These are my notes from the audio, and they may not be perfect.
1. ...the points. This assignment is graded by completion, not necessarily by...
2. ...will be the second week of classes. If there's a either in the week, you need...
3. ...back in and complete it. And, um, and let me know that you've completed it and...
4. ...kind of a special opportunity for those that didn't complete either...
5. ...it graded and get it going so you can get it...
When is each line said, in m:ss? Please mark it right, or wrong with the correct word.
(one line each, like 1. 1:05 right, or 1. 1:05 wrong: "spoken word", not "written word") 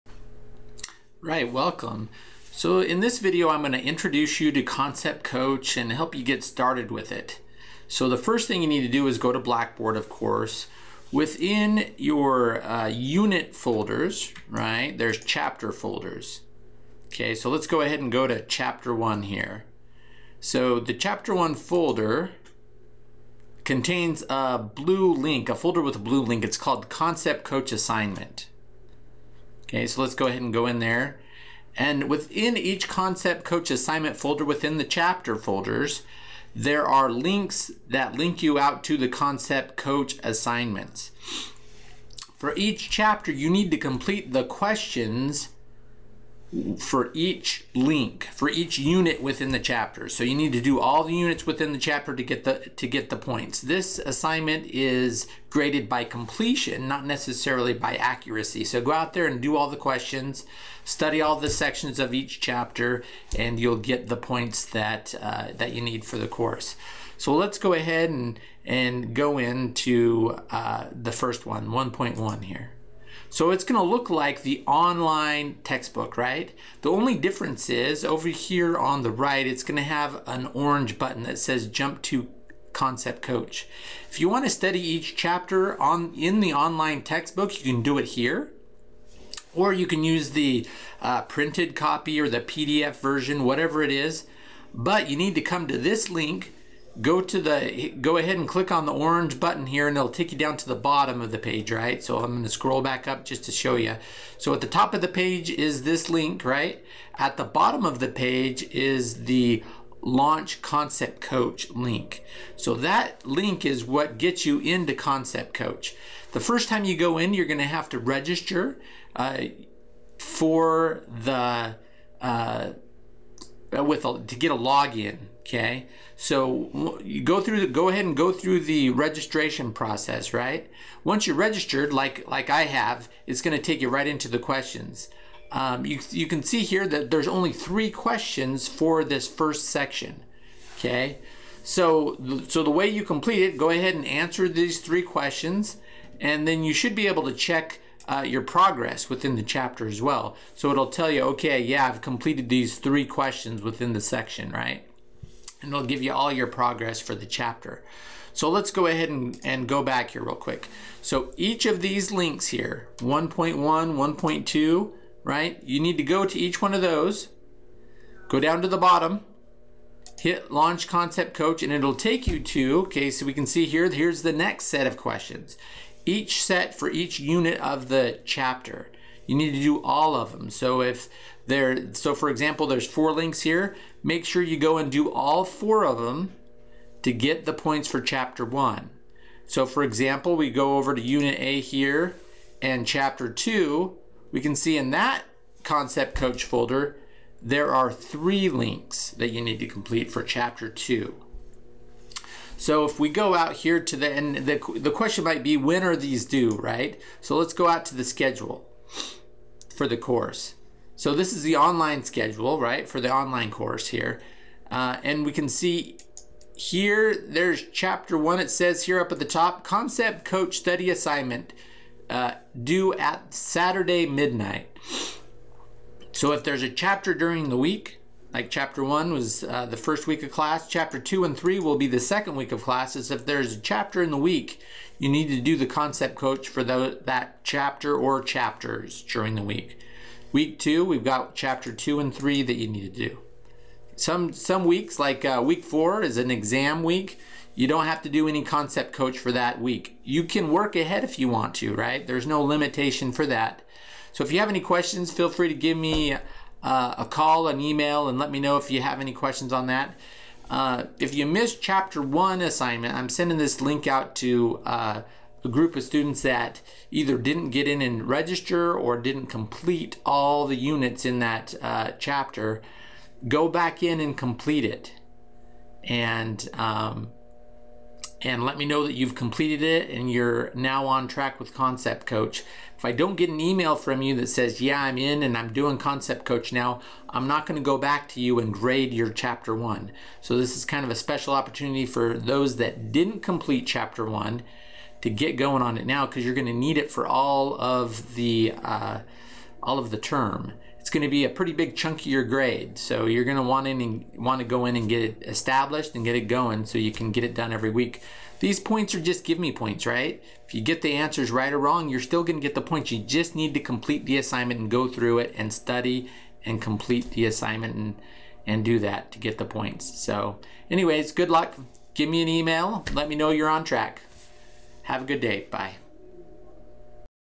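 1. 0:53 right
2. 3:51 wrong: "chapter", not "either"
3. 4:33 right
4. 4:50 wrong: "chapter", not "either"
5. 5:05 wrong: "established", not "graded".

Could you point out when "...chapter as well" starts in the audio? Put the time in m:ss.
2:29.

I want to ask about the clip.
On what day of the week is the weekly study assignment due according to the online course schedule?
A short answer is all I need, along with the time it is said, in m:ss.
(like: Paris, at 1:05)
Saturday, at 3:43.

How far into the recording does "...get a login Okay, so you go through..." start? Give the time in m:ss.
2:04.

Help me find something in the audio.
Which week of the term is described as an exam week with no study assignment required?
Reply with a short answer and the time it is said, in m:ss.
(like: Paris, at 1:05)
week 4, at 4:05.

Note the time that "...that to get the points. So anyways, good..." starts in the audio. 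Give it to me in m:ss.
5:18.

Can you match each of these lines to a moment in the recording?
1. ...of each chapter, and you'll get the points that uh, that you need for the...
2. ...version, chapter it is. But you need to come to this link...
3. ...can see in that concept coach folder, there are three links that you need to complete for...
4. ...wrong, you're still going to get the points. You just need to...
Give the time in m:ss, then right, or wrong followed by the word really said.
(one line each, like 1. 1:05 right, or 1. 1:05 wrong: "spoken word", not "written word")
1. 1:01 right
2. 1:32 wrong: "whatever", not "chapter"
3. 3:14 right
4. 5:11 right.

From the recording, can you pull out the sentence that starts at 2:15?
Um, you, you can see here that there's only three questions for this first section.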